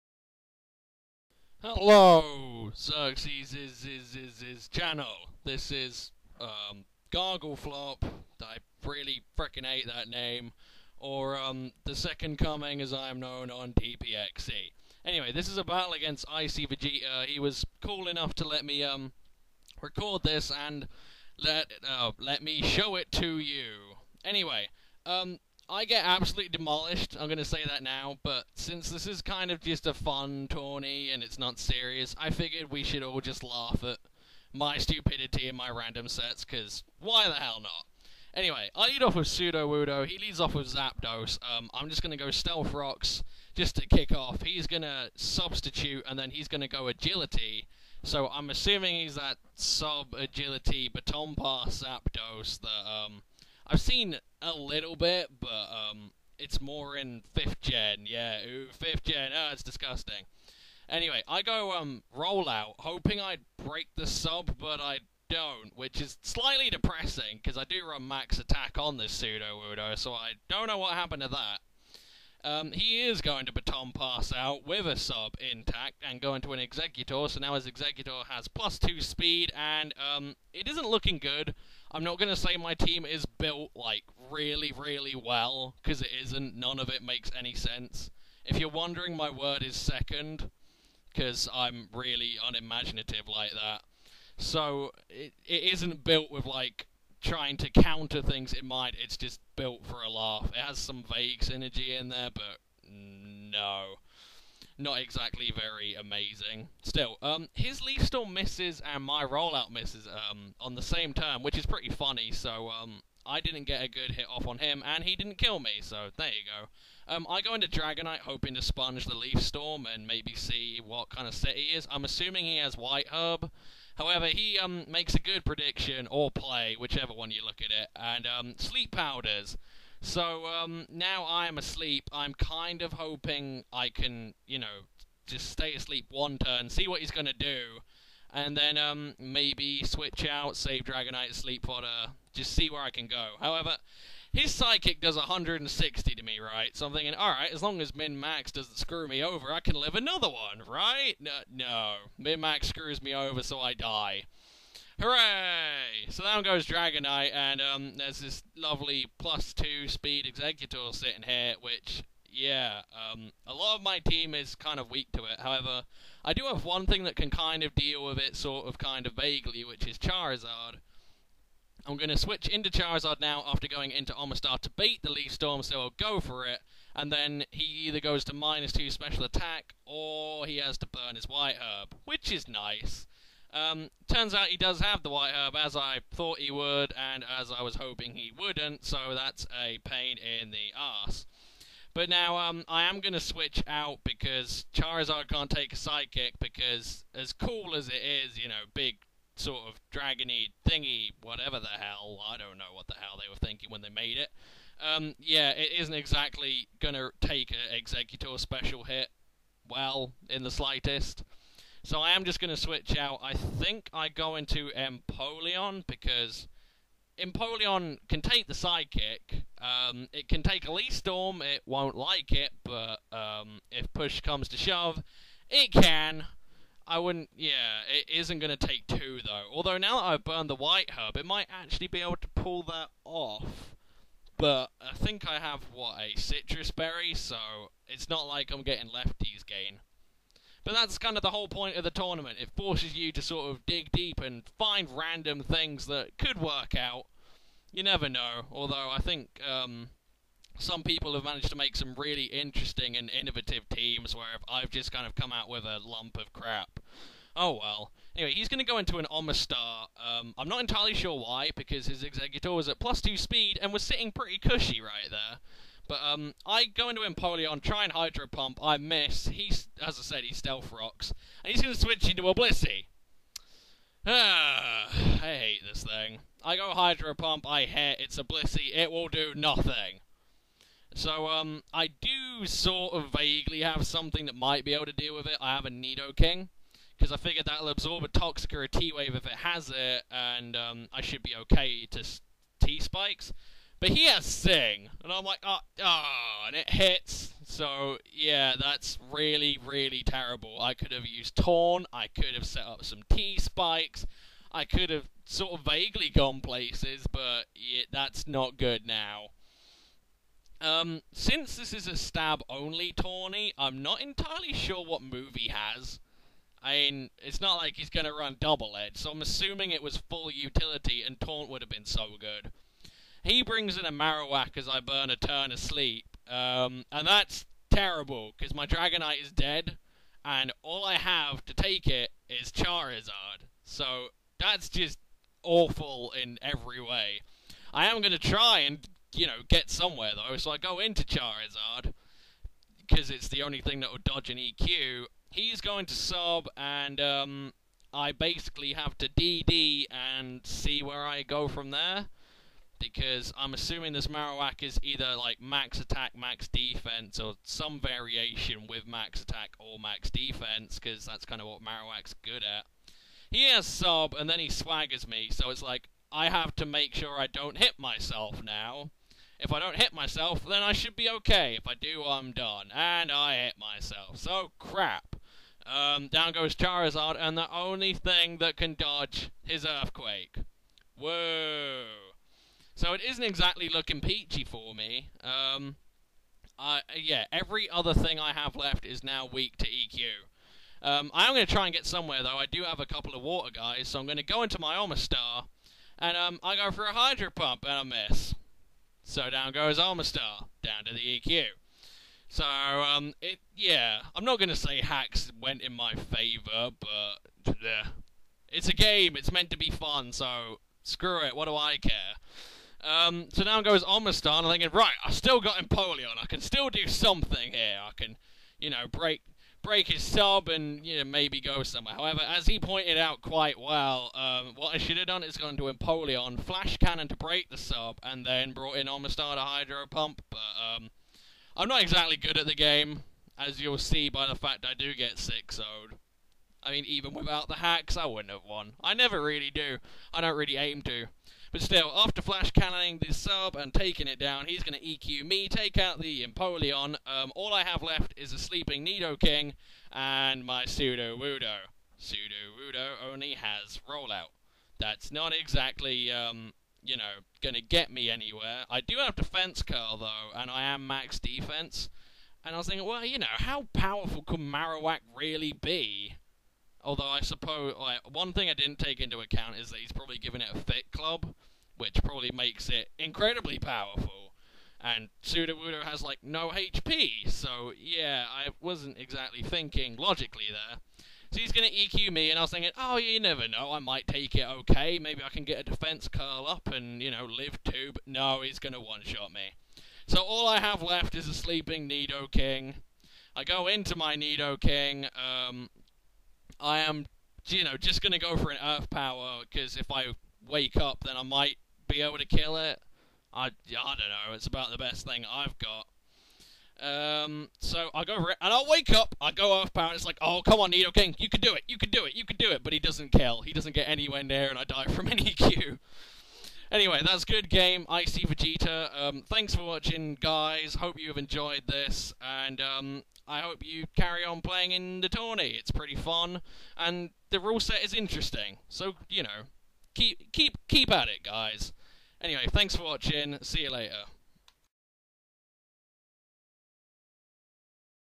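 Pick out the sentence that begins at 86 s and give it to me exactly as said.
None of it makes any sense.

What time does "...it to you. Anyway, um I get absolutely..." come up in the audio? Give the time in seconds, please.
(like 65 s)
22 s.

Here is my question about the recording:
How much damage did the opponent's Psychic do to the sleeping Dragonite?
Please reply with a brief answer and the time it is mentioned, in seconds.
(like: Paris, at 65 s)
160, at 145 s.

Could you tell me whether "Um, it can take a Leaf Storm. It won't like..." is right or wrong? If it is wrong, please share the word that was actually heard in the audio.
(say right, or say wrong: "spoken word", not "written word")
right.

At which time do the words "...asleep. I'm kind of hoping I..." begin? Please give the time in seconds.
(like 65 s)
131 s.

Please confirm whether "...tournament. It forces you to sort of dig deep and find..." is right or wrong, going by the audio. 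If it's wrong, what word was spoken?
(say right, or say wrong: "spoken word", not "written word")
right.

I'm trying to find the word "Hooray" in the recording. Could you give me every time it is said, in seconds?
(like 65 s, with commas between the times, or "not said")
155 s.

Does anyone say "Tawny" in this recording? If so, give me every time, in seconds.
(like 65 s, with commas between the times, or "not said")
312 s.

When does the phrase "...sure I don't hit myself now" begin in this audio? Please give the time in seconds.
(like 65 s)
366 s.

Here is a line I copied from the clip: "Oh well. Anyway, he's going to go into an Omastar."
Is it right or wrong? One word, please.
right.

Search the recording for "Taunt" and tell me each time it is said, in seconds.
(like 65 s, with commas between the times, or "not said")
301 s, 321 s.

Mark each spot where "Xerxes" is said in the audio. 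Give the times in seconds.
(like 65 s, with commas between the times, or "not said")
2 s.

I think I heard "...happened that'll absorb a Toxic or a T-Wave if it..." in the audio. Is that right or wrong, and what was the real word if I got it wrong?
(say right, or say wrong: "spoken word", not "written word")
wrong: "figured", not "happened".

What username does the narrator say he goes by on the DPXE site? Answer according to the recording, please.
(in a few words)
The Second Coming.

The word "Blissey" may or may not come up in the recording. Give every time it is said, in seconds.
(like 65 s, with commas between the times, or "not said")
272 s, 278 s.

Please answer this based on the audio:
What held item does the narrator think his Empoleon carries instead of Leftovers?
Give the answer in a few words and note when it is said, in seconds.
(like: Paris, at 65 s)
Sitrus Berry, at 236 s.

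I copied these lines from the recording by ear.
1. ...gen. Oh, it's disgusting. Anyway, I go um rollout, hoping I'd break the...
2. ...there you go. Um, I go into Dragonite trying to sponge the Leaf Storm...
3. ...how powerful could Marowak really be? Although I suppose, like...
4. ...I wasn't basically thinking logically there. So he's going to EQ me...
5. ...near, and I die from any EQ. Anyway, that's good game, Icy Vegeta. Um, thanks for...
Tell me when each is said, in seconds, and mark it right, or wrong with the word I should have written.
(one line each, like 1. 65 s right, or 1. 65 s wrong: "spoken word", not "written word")
1. 59 s right
2. 116 s wrong: "hoping", not "trying"
3. 463 s right
4. 478 s wrong: "exactly", not "basically"
5. 514 s right.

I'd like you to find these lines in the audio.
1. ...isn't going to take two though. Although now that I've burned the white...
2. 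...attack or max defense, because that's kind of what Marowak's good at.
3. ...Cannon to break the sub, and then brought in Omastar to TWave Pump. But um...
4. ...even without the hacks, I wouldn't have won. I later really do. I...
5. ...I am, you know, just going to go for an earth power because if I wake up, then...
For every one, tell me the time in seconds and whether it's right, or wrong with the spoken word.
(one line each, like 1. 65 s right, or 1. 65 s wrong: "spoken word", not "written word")
1. 228 s right
2. 359 s right
3. 426 s wrong: "Hydro", not "TWave"
4. 436 s wrong: "never", not "later"
5. 496 s right.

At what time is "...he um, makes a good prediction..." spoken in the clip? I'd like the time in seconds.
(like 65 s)
124 s.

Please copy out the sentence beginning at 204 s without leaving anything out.
Um, yeah, it isn't exactly going to take an Exeggutor special hit well in the slightest.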